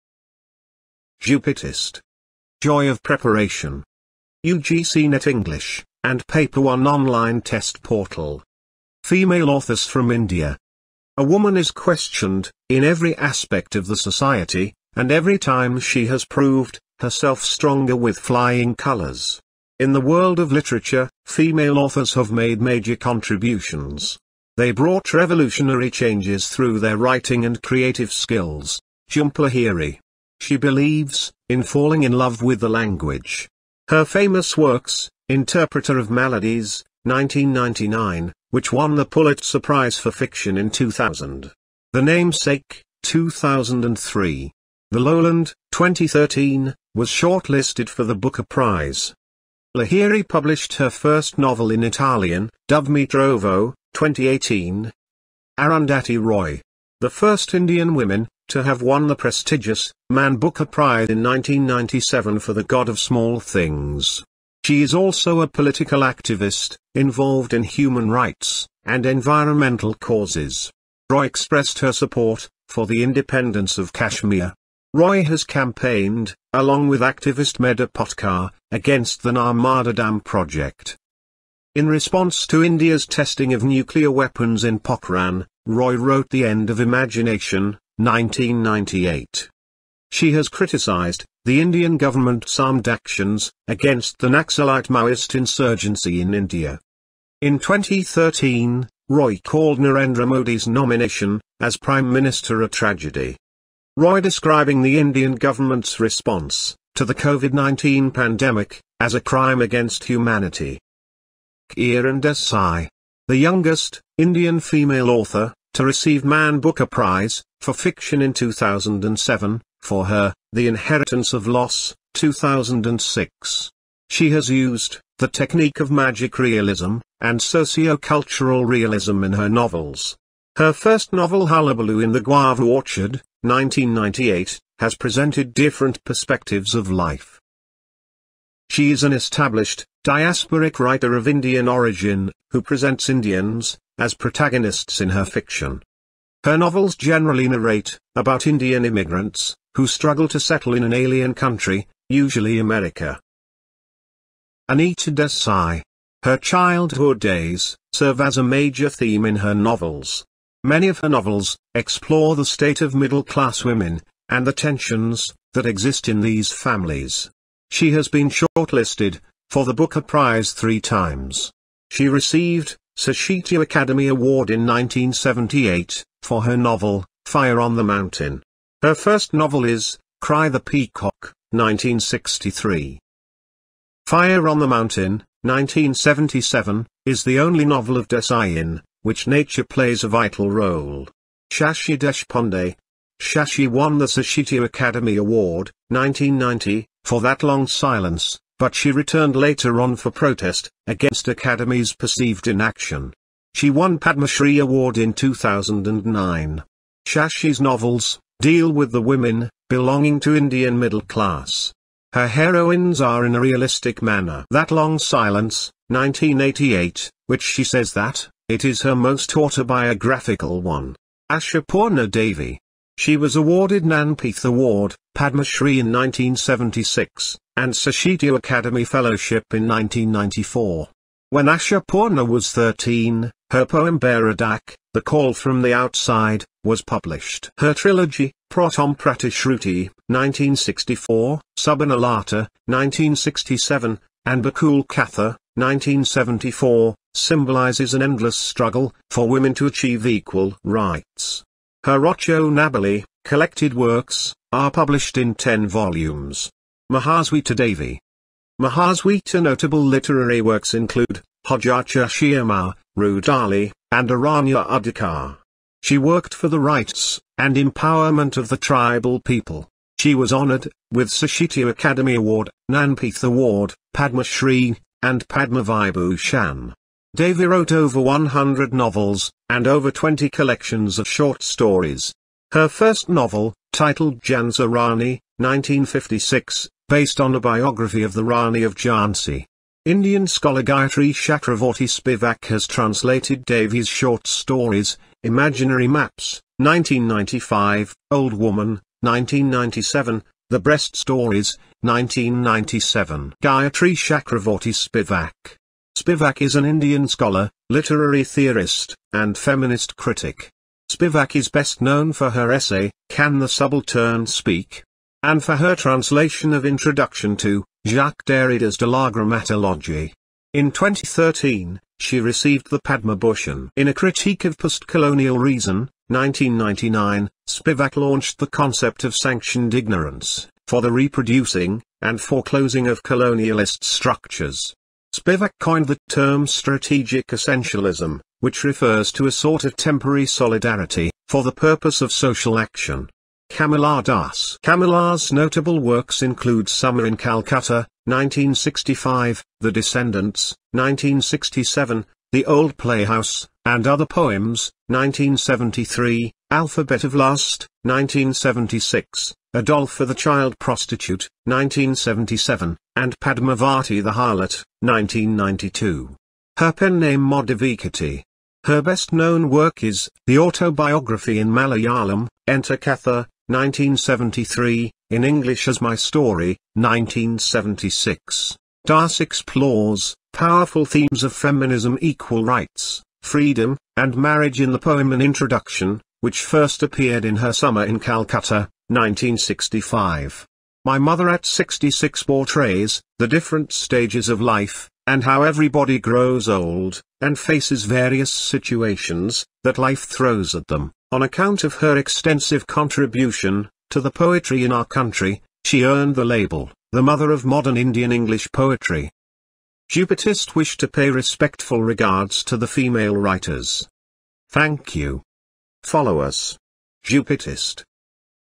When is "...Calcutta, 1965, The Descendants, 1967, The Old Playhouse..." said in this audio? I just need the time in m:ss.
5:47.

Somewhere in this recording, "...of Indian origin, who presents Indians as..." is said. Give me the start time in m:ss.
2:21.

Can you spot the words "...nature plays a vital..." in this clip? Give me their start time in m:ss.
3:09.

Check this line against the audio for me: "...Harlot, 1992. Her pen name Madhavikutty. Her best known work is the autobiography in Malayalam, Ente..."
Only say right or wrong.
right.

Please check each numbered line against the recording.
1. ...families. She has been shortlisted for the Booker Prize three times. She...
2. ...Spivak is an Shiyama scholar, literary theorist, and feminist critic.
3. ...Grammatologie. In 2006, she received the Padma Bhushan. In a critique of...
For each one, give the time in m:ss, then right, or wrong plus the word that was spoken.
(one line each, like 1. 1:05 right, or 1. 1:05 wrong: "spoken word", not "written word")
1. 2:46 right
2. 5:05 wrong: "Indian", not "Shiyama"
3. 5:19 wrong: "2013", not "2006".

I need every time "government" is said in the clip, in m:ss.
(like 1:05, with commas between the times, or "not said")
1:31, 1:45.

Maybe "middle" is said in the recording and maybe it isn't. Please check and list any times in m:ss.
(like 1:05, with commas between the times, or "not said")
2:42, 3:30.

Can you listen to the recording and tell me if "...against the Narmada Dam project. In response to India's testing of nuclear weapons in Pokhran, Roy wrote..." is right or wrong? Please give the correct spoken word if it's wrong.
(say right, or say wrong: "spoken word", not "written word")
right.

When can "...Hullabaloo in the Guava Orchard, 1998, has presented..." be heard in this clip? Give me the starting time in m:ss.
2:11.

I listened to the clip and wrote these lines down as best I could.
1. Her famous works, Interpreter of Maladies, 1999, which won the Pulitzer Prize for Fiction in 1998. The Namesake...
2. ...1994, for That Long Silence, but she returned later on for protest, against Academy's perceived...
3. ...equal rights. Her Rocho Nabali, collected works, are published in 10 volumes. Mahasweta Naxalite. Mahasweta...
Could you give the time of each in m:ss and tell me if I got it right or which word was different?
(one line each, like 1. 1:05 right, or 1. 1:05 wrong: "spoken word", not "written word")
1. 0:33 wrong: "2000", not "1998"
2. 3:15 wrong: "1990", not "1994"
3. 4:10 wrong: "Devi", not "Naxalite".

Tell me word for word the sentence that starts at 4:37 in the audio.
Devi wrote over 100 novels and over 20 collections of short stories.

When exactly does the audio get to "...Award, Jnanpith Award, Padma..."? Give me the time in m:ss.
4:32.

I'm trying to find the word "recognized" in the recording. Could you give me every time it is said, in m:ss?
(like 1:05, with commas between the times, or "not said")
not said.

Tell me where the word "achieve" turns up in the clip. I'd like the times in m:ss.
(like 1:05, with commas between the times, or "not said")
4:09.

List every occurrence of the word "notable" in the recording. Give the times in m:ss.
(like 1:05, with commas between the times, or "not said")
4:19, 5:45.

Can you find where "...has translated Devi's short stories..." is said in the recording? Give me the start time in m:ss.
4:52.